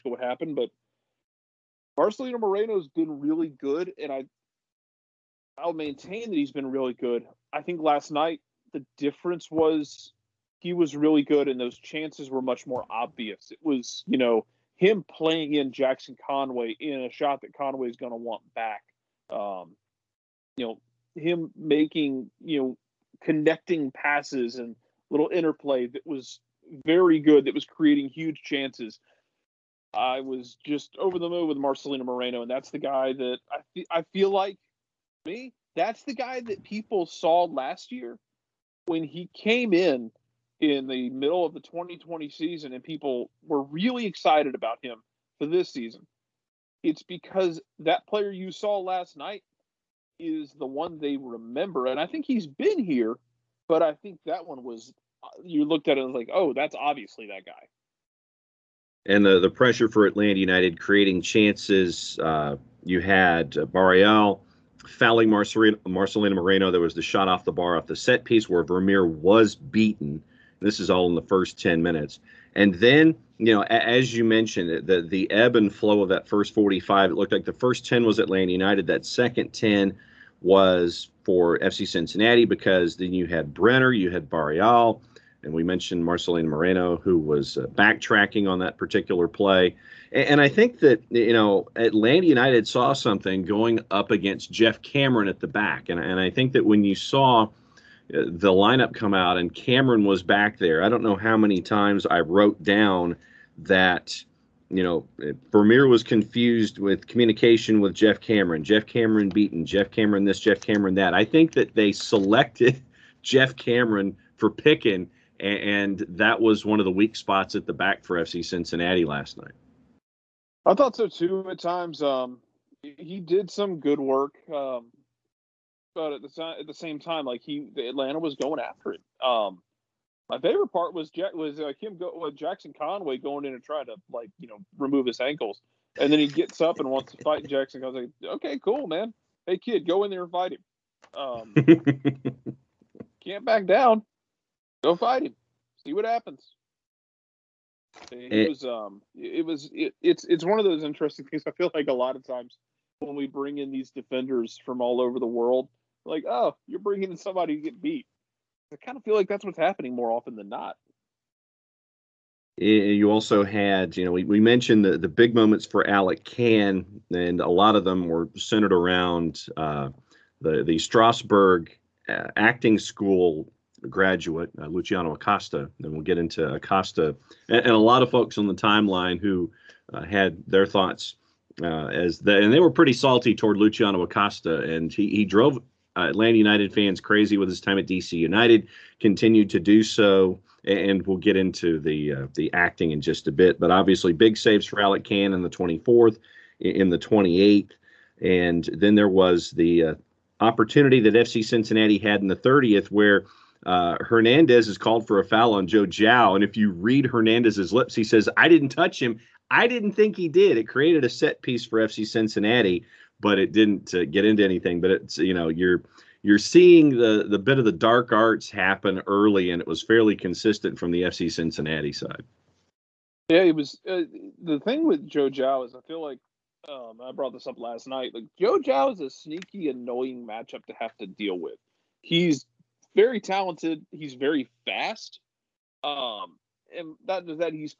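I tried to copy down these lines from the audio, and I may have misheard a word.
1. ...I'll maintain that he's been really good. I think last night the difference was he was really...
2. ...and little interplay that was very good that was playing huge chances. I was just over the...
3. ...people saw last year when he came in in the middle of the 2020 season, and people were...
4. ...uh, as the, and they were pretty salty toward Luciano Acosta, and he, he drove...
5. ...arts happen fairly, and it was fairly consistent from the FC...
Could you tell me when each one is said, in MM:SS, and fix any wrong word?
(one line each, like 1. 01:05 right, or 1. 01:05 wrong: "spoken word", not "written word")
1. 00:05 right
2. 00:24 wrong: "creating", not "playing"
3. 00:36 right
4. 03:01 right
5. 03:38 wrong: "early", not "fairly".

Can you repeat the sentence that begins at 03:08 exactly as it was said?
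Continued to do so, and we'll get into the uh, the acting in just a bit.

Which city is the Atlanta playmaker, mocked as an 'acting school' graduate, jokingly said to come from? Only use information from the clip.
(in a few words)
Strasbourg.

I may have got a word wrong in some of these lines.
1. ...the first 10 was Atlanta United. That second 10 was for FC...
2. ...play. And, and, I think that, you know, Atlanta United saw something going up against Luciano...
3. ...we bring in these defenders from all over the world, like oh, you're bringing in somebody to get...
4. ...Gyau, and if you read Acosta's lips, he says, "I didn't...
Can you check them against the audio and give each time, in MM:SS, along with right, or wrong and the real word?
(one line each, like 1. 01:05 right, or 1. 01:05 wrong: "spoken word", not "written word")
1. 01:17 right
2. 01:29 wrong: "Geoff", not "Luciano"
3. 02:33 right
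4. 03:25 wrong: "Hernandez", not "Acosta".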